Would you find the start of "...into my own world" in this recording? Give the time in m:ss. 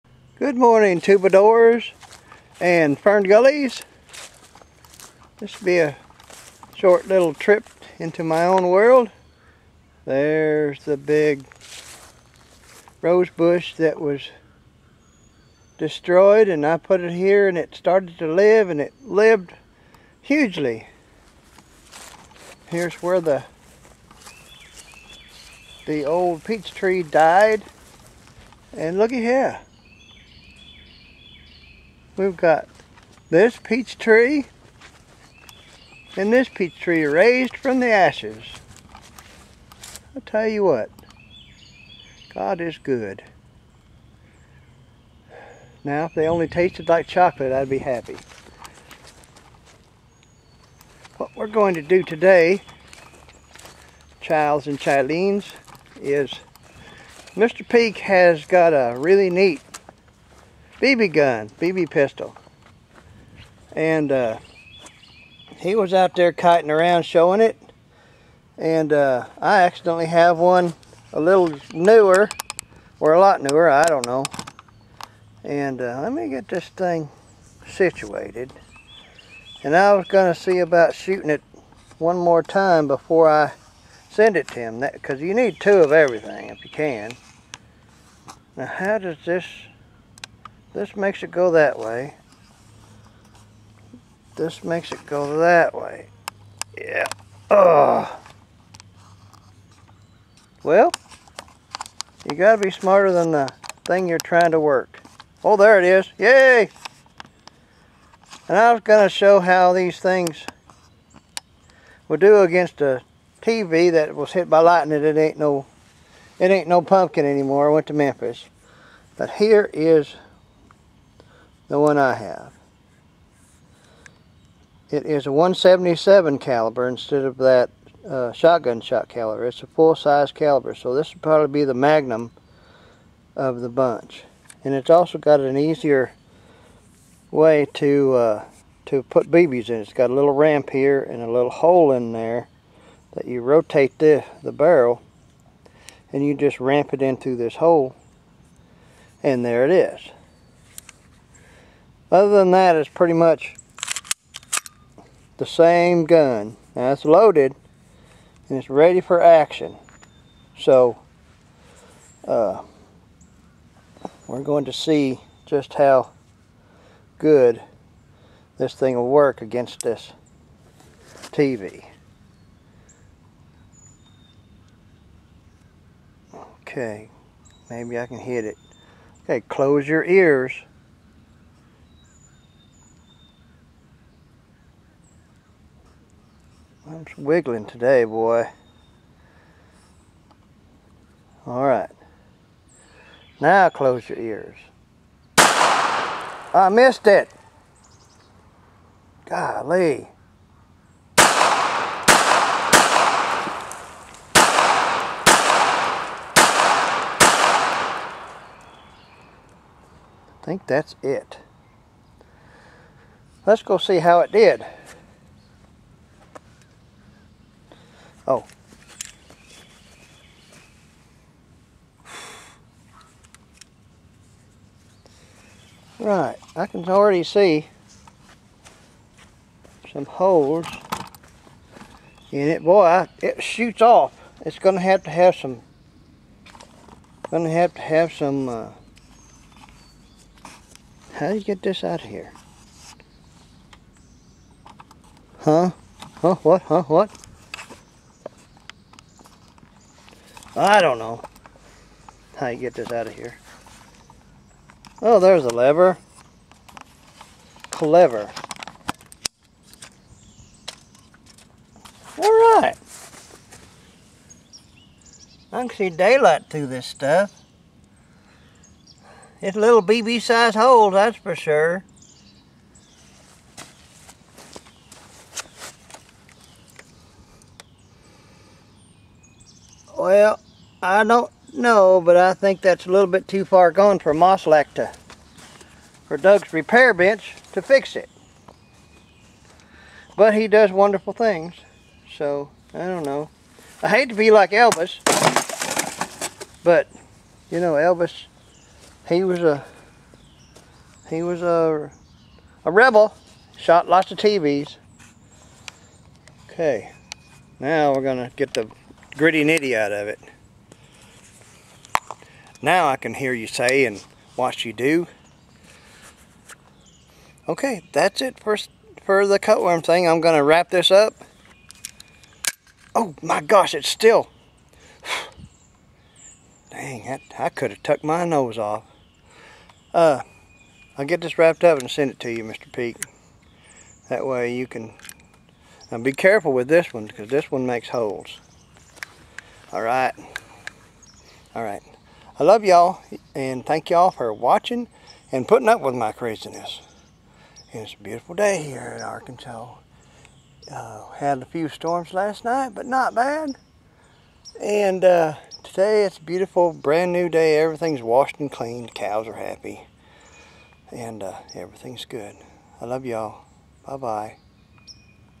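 0:07.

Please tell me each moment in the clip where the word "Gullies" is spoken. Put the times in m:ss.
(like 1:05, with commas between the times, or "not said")
0:03.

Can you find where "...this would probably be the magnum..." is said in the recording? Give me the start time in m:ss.
2:10.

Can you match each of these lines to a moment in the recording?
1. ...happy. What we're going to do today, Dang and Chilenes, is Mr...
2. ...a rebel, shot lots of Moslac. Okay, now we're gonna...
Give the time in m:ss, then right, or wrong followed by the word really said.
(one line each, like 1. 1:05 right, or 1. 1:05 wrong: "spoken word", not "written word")
1. 0:47 wrong: "Childs", not "Dang"
2. 5:02 wrong: "TVs", not "Moslac".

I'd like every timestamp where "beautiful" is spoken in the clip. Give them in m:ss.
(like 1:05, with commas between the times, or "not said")
5:48, 5:56.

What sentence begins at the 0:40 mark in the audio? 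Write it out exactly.
I tell you what, God is good.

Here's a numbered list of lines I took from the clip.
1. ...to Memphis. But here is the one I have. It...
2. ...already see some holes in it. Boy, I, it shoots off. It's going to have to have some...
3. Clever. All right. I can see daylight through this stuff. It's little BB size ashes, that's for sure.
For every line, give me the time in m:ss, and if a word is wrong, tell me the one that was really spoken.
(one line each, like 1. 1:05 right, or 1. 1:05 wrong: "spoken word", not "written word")
1. 1:57 right
2. 3:46 right
3. 4:17 wrong: "holes", not "ashes".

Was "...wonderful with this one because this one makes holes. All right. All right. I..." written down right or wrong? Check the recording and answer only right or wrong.
wrong.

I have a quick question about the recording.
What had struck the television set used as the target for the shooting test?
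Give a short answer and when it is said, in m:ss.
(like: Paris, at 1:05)
Lightning, at 1:54.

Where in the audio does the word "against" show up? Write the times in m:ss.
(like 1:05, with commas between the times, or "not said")
1:52, 2:49.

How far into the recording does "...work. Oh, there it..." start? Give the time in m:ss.
1:44.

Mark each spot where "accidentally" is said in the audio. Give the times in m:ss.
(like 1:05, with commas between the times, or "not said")
1:09.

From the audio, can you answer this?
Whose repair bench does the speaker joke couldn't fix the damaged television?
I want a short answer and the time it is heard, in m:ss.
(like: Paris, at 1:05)
Doug's, at 4:46.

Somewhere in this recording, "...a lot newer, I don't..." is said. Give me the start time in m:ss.
1:13.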